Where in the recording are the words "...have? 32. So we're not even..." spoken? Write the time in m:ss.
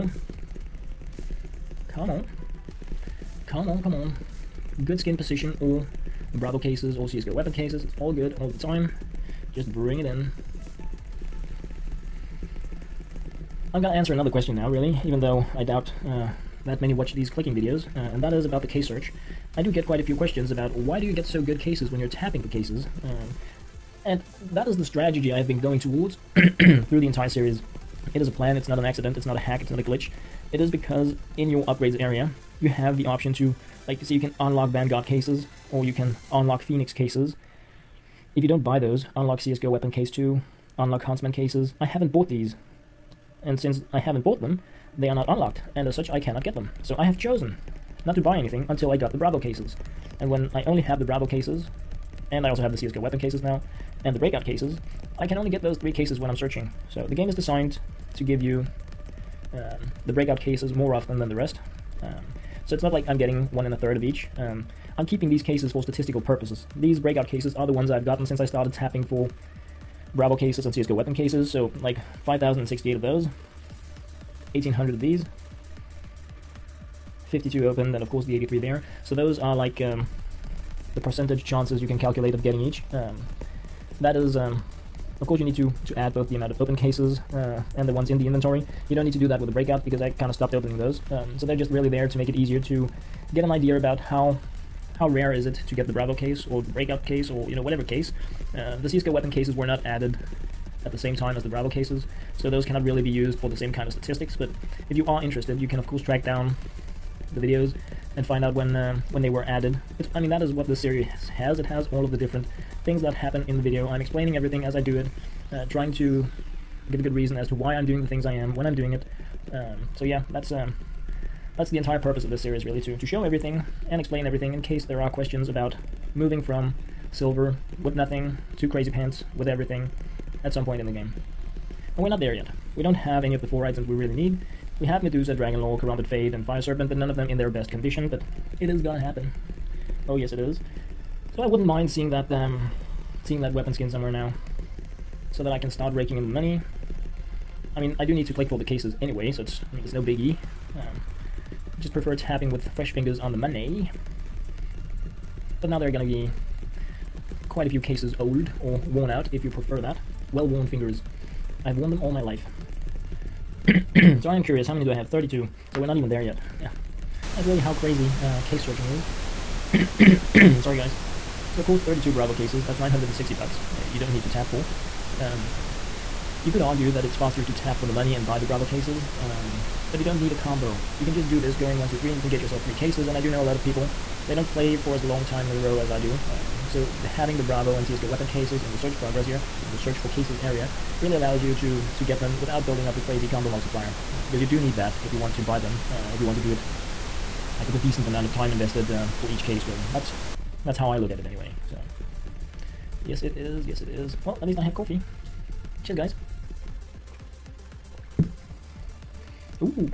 2:44.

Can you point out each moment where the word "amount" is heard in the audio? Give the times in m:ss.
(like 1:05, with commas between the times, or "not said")
1:26, 3:18.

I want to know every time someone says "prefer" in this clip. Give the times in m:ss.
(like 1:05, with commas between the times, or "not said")
2:31, 2:39.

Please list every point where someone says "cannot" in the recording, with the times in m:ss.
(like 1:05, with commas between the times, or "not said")
0:46, 1:42.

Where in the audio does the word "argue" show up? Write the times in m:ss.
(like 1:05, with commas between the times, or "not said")
2:56.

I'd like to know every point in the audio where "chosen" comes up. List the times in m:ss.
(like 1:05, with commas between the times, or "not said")
0:47.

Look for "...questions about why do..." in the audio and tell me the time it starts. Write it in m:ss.
0:20.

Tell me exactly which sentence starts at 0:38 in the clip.
If you don't buy those, unlock CSGO weapon case 2, unlock Huntsman cases.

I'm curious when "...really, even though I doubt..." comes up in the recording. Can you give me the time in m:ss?
0:14.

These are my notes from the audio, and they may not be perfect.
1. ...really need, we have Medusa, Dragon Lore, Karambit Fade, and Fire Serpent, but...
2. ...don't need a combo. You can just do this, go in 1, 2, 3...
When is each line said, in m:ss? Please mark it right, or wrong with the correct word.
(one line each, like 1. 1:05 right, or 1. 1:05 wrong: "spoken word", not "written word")
1. 2:13 right
2. 3:00 right.